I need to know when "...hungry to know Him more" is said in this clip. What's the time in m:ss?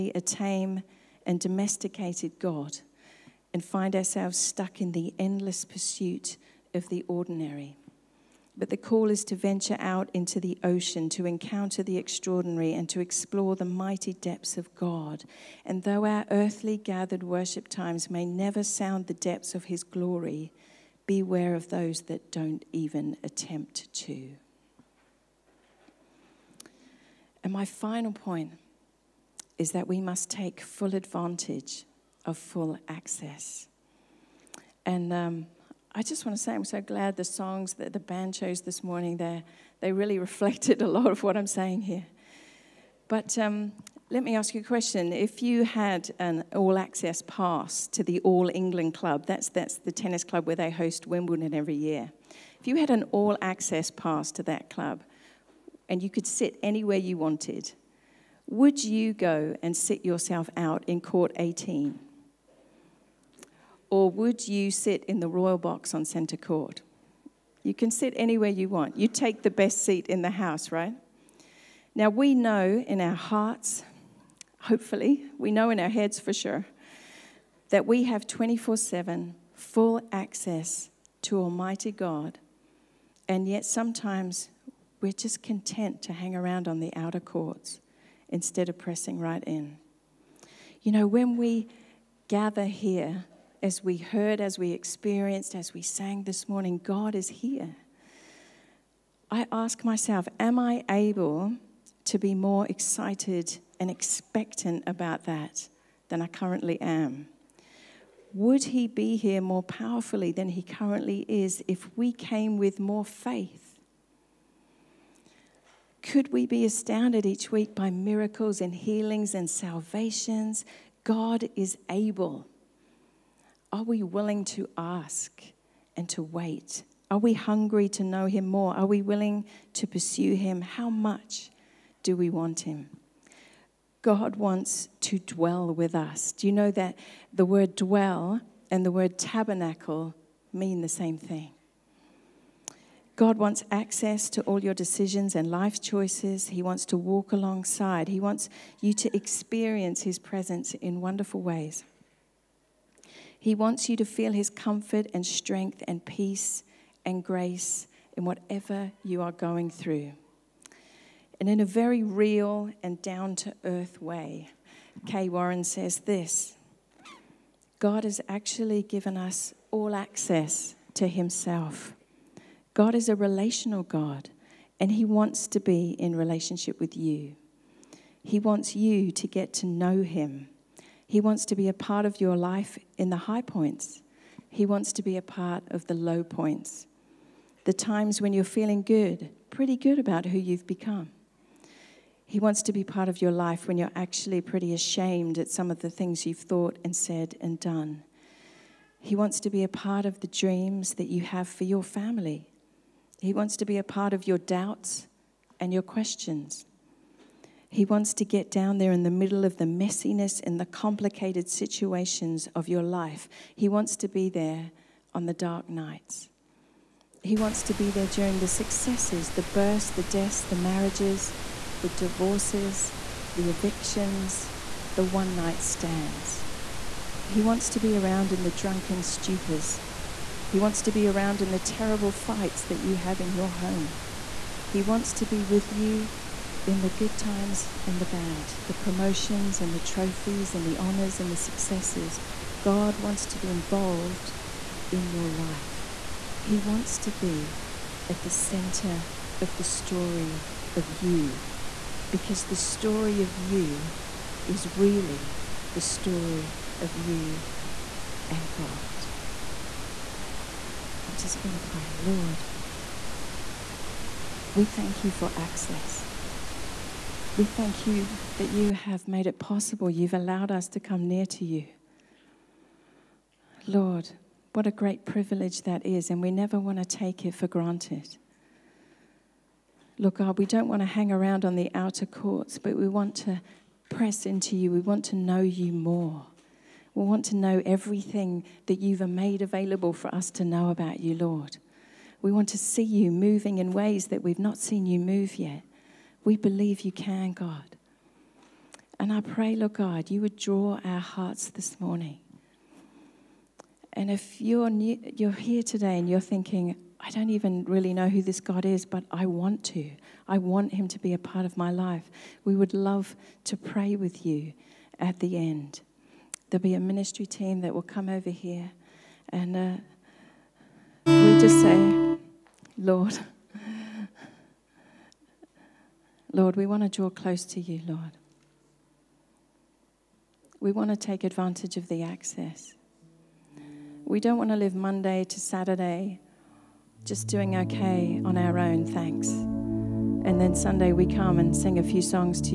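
2:07.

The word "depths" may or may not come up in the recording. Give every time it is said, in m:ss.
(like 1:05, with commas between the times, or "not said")
0:14, 0:19.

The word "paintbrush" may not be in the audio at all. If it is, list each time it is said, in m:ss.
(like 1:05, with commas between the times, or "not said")
not said.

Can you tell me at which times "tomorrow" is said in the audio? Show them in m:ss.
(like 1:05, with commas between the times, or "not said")
not said.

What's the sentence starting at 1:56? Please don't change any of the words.
Could we be astounded each week by miracles and healings and salvations?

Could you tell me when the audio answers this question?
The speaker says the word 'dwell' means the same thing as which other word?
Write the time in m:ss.
2:19.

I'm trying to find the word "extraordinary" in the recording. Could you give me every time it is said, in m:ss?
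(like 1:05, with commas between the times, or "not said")
0:11.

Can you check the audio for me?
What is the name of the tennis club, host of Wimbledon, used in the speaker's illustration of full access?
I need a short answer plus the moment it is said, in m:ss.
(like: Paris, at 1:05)
All England Club, at 0:48.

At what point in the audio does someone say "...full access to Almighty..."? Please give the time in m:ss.
1:19.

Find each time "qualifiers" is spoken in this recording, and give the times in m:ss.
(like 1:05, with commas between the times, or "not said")
not said.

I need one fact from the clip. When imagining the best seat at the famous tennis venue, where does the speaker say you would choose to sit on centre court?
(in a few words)
The royal box.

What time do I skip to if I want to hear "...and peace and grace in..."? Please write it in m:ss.
2:35.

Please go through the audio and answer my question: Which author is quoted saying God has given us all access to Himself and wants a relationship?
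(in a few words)
Kay Warren.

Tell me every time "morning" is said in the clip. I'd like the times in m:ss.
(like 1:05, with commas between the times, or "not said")
0:38, 1:36, 5:01.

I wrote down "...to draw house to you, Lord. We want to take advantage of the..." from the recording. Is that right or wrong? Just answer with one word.
wrong.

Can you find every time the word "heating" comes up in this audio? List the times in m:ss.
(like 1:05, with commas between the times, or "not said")
not said.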